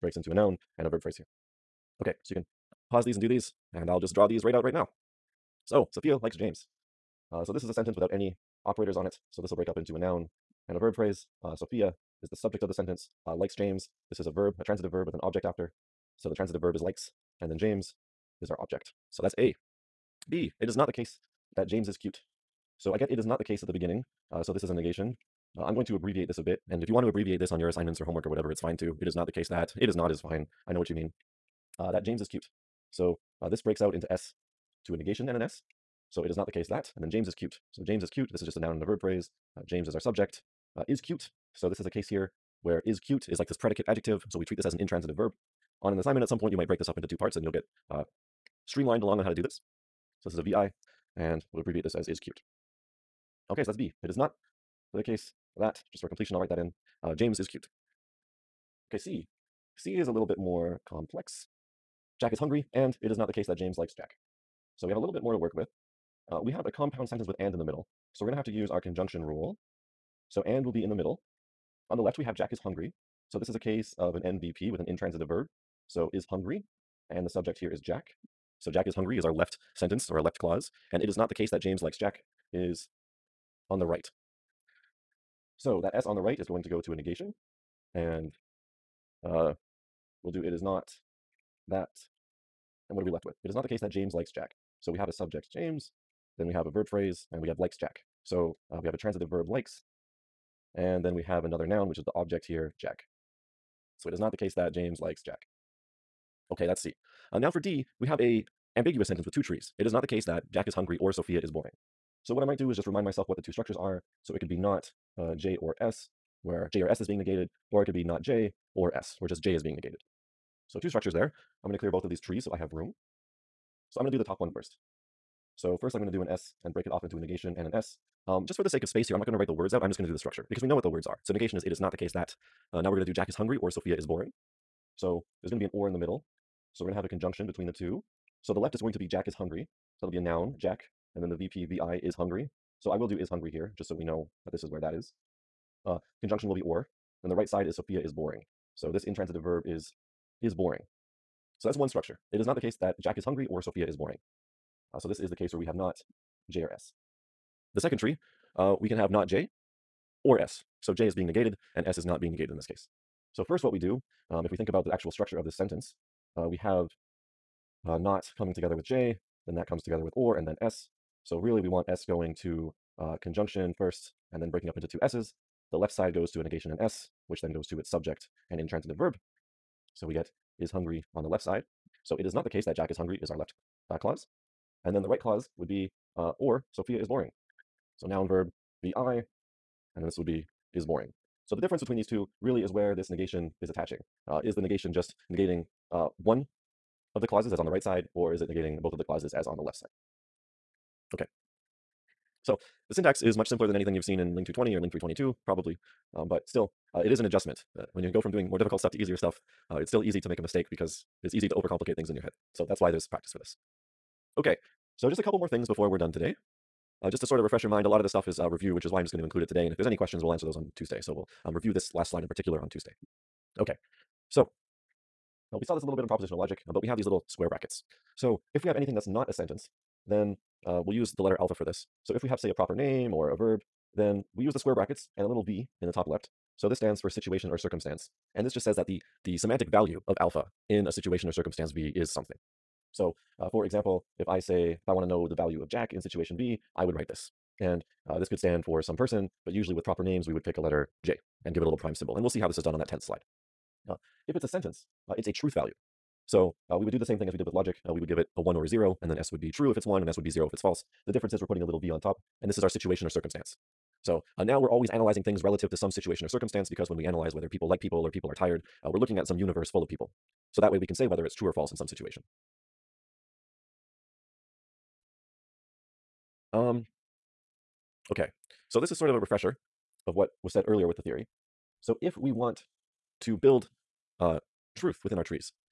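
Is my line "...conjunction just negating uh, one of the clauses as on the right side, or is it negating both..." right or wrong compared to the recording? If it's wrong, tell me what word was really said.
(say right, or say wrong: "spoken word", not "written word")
wrong: "negation", not "conjunction".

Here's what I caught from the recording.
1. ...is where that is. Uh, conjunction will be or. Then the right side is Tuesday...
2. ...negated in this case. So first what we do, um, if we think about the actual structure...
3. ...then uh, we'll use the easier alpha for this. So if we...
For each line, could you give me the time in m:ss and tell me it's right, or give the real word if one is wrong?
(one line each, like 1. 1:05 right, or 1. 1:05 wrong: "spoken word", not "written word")
1. 2:24 wrong: "Sophia", not "Tuesday"
2. 2:42 right
3. 3:50 wrong: "letter", not "easier".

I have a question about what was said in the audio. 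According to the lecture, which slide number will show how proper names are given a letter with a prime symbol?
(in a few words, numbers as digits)
10.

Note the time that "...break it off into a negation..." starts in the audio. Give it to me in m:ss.
2:06.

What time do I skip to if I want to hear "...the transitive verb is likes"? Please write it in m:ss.
0:16.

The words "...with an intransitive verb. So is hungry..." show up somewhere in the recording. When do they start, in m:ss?
1:14.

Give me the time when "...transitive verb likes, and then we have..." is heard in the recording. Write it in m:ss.
1:38.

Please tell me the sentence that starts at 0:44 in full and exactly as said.
So we treat this as an intransitive verb.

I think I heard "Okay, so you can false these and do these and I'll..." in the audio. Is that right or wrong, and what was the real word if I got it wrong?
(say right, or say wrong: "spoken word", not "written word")
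wrong: "pause", not "false".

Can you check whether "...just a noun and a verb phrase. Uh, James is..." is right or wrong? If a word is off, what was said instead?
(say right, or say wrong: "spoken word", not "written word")
right.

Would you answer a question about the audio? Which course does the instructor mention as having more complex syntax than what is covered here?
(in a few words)
Ling 220.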